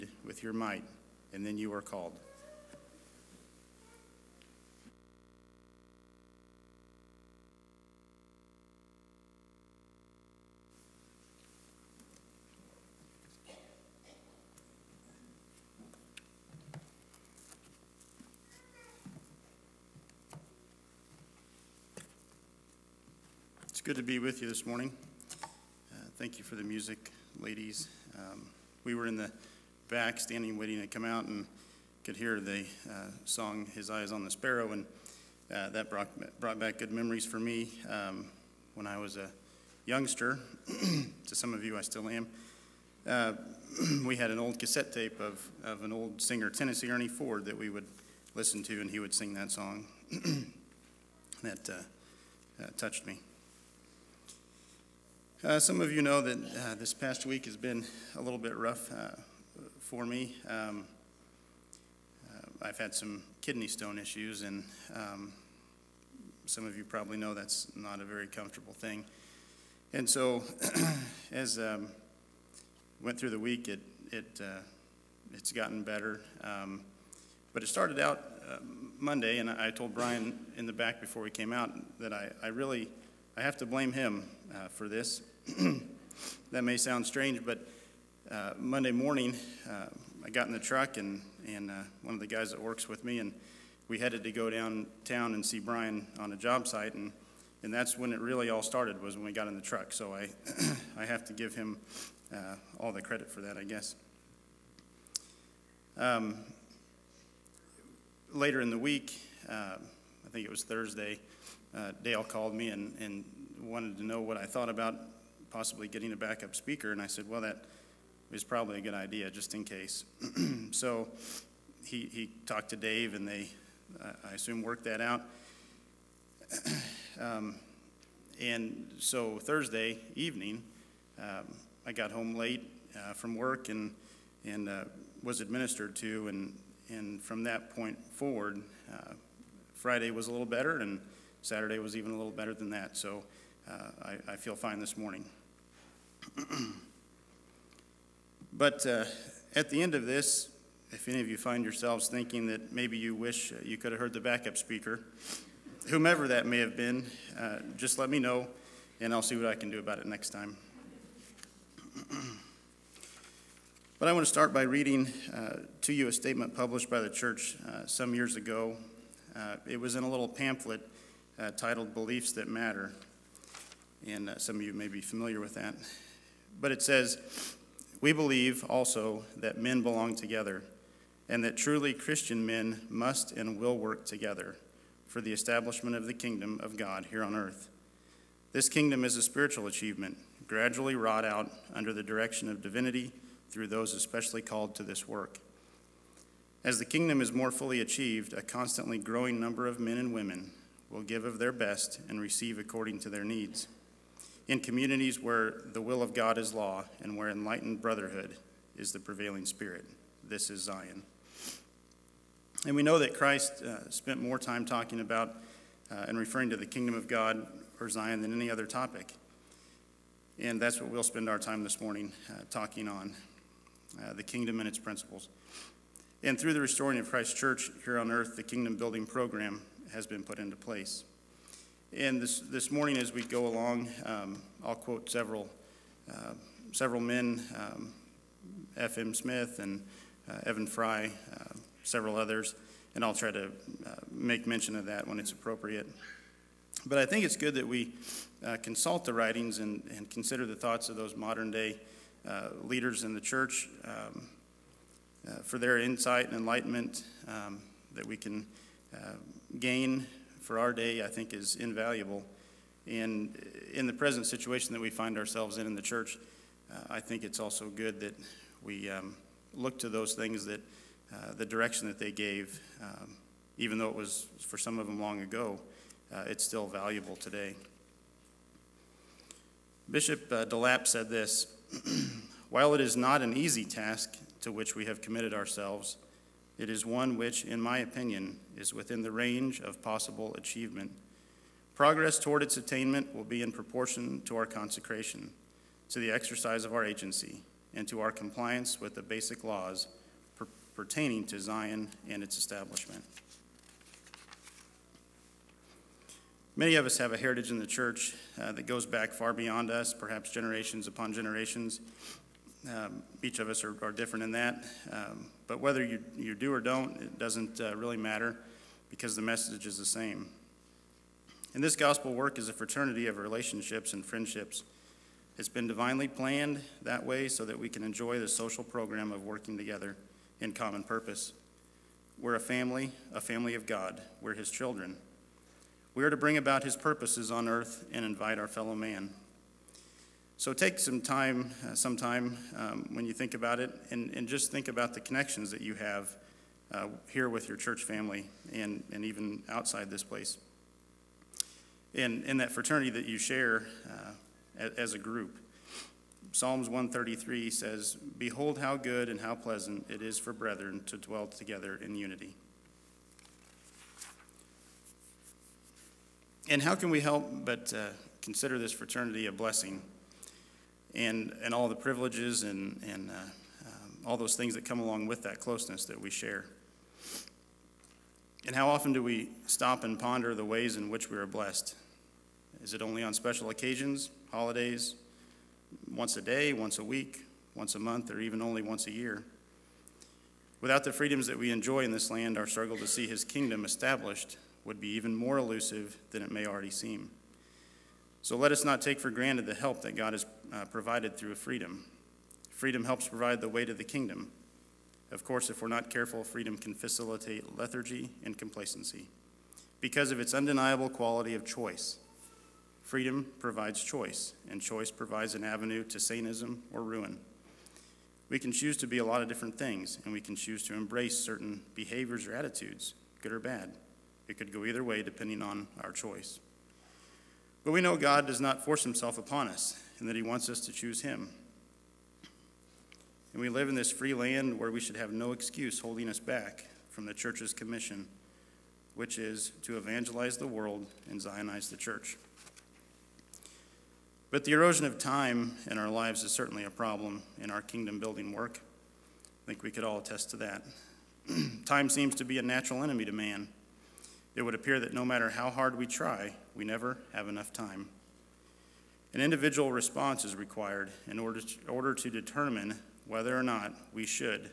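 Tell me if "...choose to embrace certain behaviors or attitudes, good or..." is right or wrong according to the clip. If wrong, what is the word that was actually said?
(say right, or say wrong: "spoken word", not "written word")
right.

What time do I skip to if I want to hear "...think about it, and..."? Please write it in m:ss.
5:43.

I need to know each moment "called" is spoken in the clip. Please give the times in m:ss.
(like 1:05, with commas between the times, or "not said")
0:01, 1:52, 3:14.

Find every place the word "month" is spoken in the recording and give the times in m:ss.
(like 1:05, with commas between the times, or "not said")
6:27.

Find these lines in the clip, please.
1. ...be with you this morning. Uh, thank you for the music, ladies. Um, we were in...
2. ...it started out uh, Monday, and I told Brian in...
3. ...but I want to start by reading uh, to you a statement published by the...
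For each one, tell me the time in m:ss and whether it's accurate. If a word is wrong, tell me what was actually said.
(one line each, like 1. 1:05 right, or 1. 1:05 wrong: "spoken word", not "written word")
1. 0:24 right
2. 1:17 right
3. 2:43 right.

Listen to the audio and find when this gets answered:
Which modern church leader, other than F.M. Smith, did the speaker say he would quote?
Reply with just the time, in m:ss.
4:00.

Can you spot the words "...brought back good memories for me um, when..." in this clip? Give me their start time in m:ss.
0:36.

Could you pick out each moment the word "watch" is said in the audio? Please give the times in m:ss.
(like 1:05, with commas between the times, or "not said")
not said.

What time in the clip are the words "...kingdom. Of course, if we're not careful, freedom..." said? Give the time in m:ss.
6:43.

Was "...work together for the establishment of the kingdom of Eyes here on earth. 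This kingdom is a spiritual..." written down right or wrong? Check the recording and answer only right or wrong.
wrong.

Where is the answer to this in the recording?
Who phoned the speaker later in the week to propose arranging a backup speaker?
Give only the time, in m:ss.
1:52.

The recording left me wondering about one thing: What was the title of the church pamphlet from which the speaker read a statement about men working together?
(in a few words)
Beliefs That Matter.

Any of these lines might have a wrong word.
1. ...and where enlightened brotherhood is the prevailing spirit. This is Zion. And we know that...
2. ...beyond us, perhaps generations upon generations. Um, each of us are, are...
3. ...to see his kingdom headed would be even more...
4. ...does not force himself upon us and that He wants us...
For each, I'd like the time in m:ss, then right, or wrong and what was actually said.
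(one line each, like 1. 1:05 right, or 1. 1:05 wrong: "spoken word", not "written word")
1. 3:27 right
2. 5:09 right
3. 6:32 wrong: "established", not "headed"
4. 7:08 right.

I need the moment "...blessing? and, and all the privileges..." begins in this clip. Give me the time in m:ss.
6:09.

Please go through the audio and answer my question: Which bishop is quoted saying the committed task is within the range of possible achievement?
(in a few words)
DeLapp.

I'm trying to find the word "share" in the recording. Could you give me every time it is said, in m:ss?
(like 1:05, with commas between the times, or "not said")
5:53, 6:16.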